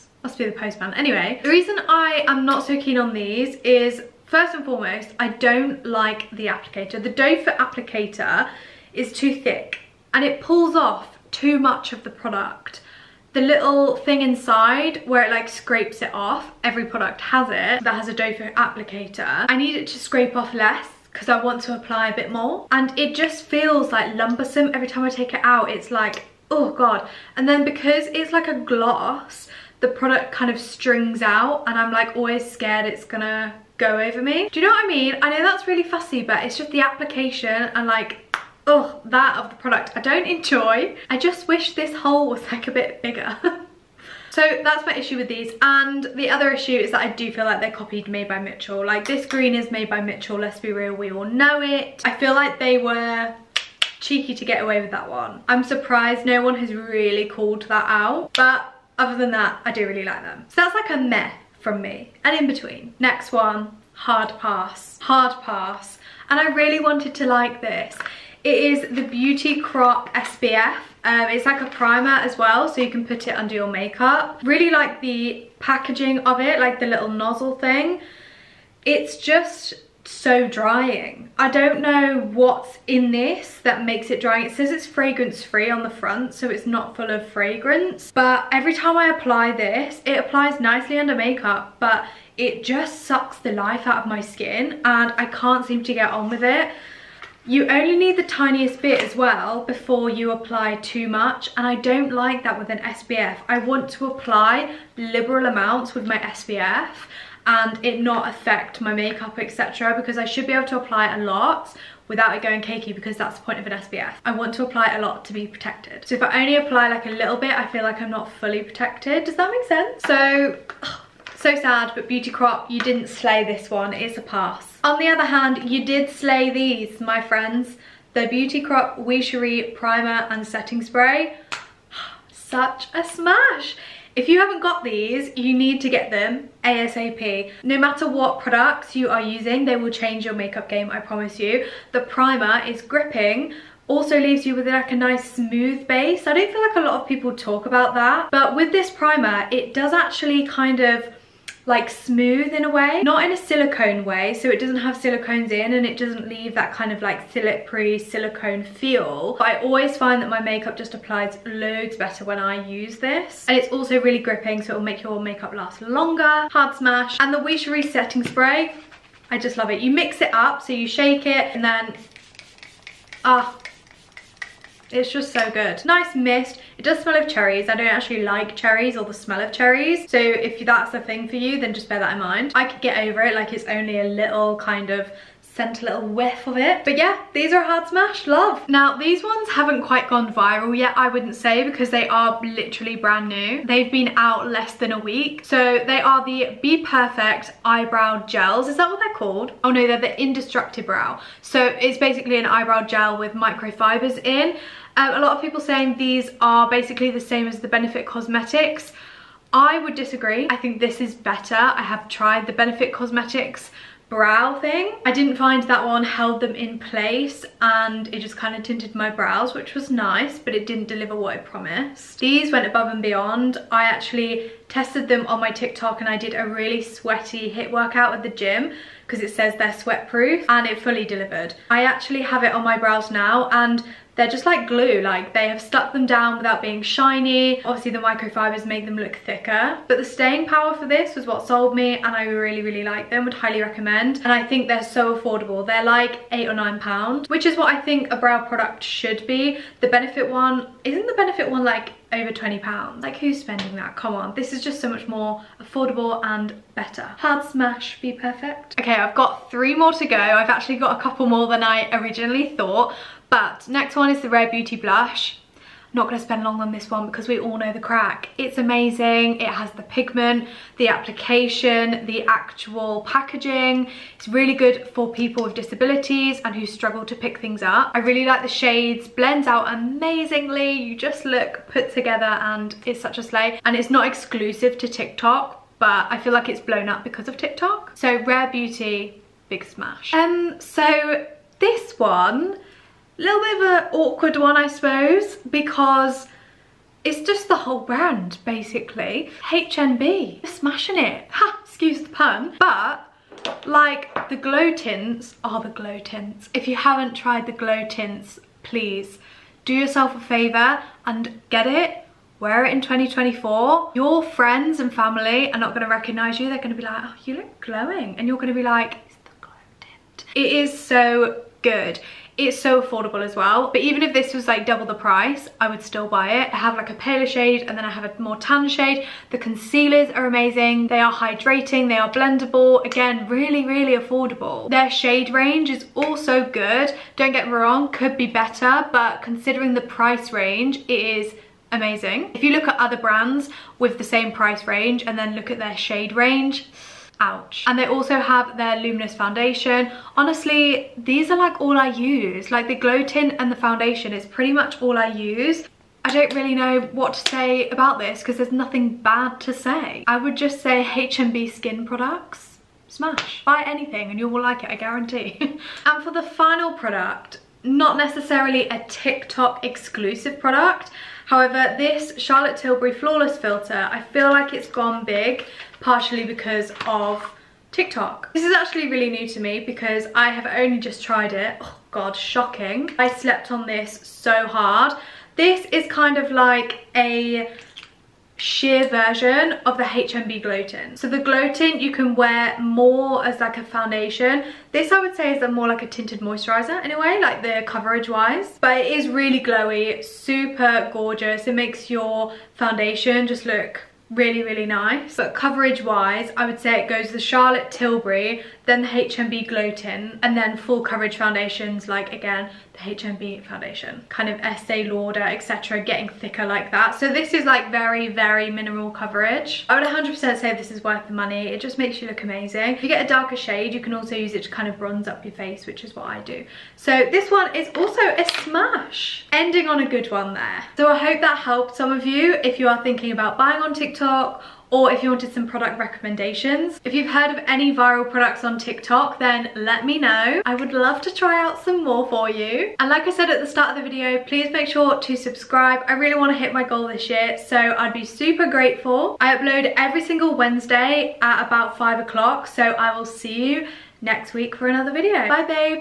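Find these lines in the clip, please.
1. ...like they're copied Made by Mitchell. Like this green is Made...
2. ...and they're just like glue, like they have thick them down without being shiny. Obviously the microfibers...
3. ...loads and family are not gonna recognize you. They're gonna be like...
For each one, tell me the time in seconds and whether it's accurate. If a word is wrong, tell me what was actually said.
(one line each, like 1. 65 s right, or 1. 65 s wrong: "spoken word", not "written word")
1. 47 s right
2. 233 s wrong: "stuck", not "thick"
3. 314 s wrong: "friends", not "loads".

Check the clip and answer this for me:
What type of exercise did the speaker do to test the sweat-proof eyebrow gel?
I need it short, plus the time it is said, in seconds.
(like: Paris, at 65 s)
HIIT workout, at 227 s.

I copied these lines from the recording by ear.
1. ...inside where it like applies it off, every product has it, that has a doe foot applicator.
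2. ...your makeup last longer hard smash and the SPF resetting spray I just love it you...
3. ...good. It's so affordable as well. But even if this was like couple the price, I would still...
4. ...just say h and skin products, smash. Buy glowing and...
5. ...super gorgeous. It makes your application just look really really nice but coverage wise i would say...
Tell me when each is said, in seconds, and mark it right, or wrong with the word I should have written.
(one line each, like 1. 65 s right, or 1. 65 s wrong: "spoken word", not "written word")
1. 14 s wrong: "scrapes", not "applies"
2. 165 s wrong: "Wish", not "SPF"
3. 321 s wrong: "double", not "couple"
4. 360 s wrong: "anything", not "glowing"
5. 400 s wrong: "foundation", not "application".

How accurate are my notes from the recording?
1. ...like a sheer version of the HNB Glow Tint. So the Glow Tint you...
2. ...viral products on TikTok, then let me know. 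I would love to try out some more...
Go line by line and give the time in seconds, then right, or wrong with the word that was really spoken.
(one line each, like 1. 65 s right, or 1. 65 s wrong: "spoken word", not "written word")
1. 386 s right
2. 437 s right.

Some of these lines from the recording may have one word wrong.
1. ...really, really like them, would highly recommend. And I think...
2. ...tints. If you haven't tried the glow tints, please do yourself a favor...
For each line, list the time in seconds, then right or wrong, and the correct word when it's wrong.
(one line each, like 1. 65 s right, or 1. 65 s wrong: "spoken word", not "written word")
1. 242 s right
2. 305 s right.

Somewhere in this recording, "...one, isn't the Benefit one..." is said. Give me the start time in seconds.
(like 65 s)
250 s.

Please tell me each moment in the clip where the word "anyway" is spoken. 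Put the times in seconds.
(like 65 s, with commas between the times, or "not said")
0 s, 396 s.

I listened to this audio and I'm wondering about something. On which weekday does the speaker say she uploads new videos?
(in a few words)
Wednesday.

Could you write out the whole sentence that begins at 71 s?
Um, it's like a primer as well, so you can put it under your makeup.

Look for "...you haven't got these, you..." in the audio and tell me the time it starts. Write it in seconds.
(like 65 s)
134 s.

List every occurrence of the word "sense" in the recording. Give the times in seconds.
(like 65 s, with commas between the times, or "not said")
119 s.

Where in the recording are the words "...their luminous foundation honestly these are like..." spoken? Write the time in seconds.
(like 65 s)
348 s.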